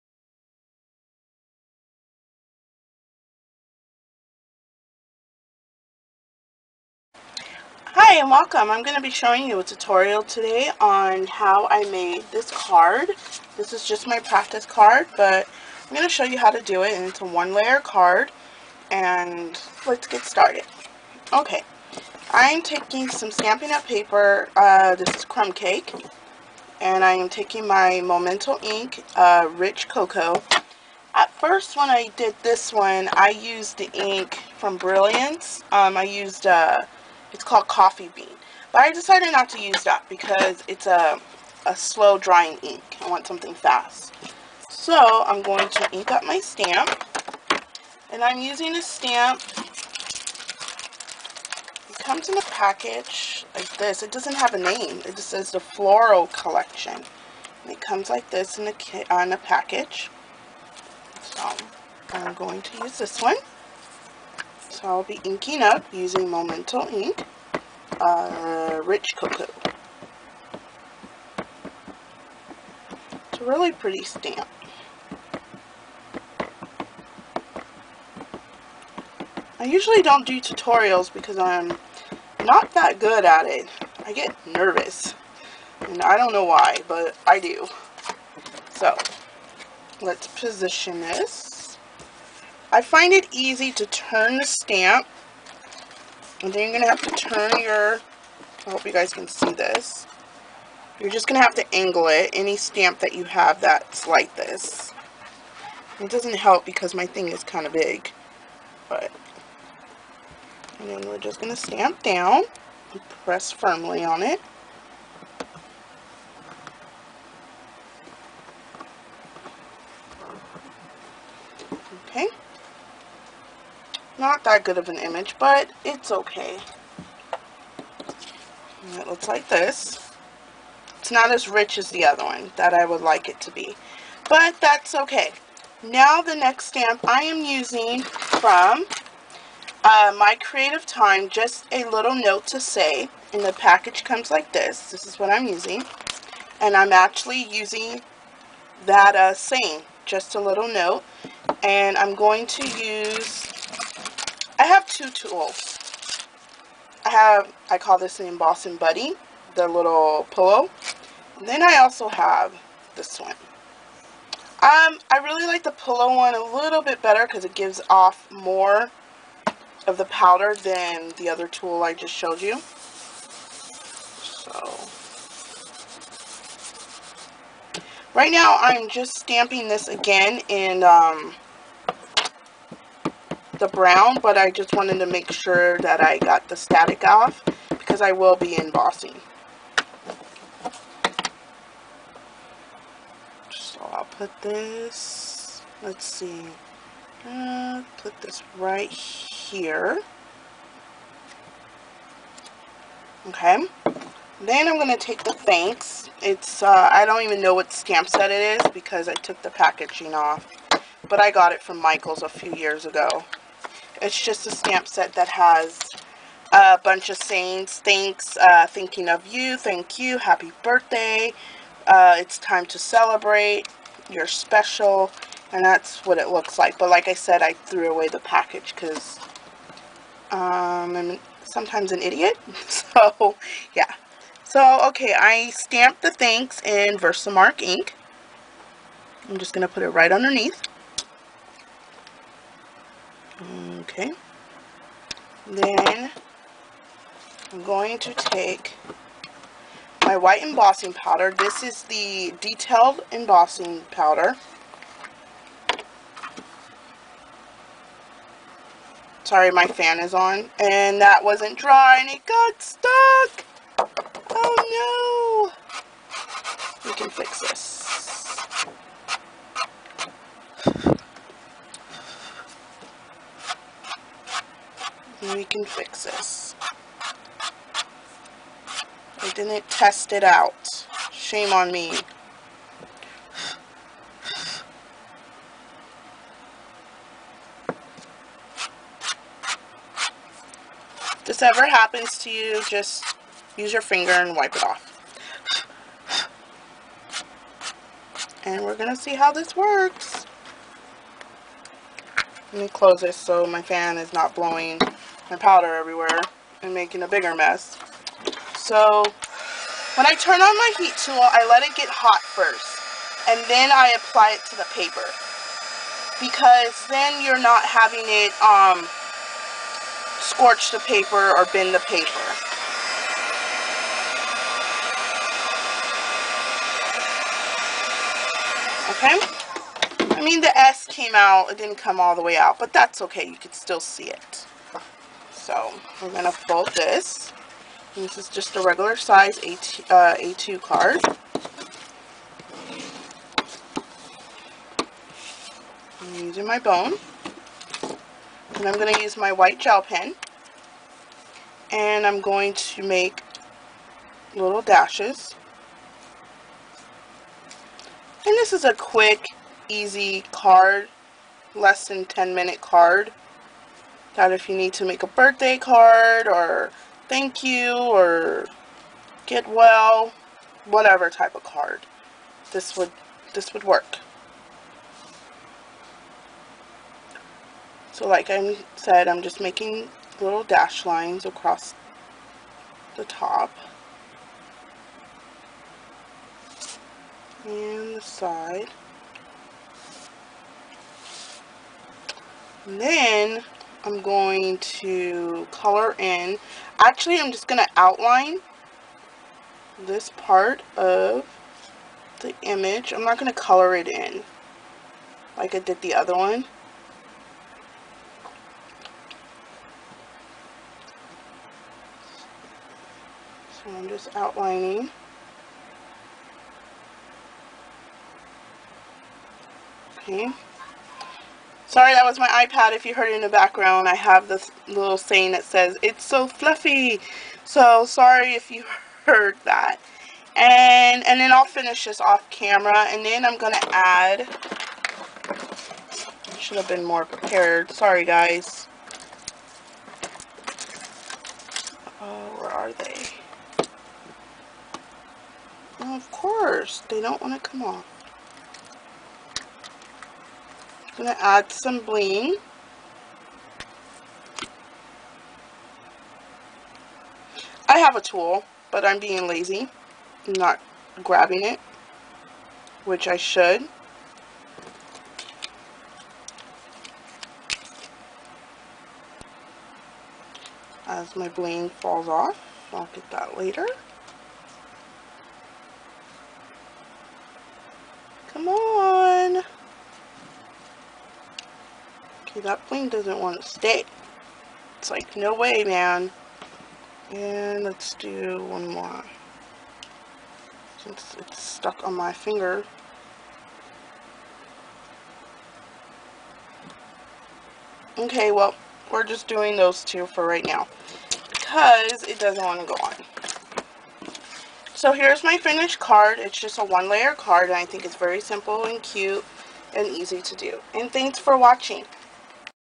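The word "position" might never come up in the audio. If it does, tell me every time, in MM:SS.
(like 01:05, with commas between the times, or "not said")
01:30.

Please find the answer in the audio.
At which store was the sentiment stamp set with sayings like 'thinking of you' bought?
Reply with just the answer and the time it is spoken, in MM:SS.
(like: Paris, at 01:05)
Michaels, at 03:31.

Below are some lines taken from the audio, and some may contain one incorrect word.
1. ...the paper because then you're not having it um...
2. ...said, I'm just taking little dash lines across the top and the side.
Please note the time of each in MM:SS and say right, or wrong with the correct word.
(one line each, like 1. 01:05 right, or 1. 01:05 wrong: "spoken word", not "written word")
1. 05:14 right
2. 06:18 wrong: "making", not "taking".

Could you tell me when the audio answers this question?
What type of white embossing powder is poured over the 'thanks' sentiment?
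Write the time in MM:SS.
04:12.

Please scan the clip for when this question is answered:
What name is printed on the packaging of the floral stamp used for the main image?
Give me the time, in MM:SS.
00:55.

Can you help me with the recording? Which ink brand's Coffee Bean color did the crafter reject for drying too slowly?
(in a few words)
Brilliance.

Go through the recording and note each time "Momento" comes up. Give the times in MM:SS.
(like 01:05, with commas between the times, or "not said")
00:27, 01:06.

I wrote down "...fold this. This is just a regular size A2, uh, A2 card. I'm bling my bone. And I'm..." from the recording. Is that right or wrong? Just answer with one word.
wrong.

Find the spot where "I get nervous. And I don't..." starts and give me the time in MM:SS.
01:24.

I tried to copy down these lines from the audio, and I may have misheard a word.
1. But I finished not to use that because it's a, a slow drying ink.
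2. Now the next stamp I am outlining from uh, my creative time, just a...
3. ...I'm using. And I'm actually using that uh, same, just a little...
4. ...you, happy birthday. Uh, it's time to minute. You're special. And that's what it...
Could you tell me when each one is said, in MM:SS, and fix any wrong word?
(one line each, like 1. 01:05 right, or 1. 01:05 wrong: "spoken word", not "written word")
1. 00:38 wrong: "decided", not "finished"
2. 02:15 wrong: "using", not "outlining"
3. 02:25 right
4. 03:39 wrong: "celebrate", not "minute".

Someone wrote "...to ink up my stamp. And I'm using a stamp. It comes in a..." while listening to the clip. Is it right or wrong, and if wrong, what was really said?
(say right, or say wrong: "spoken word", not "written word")
right.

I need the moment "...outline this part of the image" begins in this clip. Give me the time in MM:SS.
06:37.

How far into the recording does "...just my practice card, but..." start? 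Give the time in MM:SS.
00:13.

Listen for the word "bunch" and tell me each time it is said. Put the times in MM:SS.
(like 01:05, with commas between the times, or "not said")
03:36.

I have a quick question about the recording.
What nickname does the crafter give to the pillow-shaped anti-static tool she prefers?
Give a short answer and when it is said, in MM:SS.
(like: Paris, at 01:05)
embossing buddy, at 02:38.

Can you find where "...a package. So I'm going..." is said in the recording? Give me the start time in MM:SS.
00:59.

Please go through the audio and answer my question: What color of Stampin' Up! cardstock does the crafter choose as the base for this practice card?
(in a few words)
Crumb Cake.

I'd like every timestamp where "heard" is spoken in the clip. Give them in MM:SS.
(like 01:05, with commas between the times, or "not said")
07:02, 07:09.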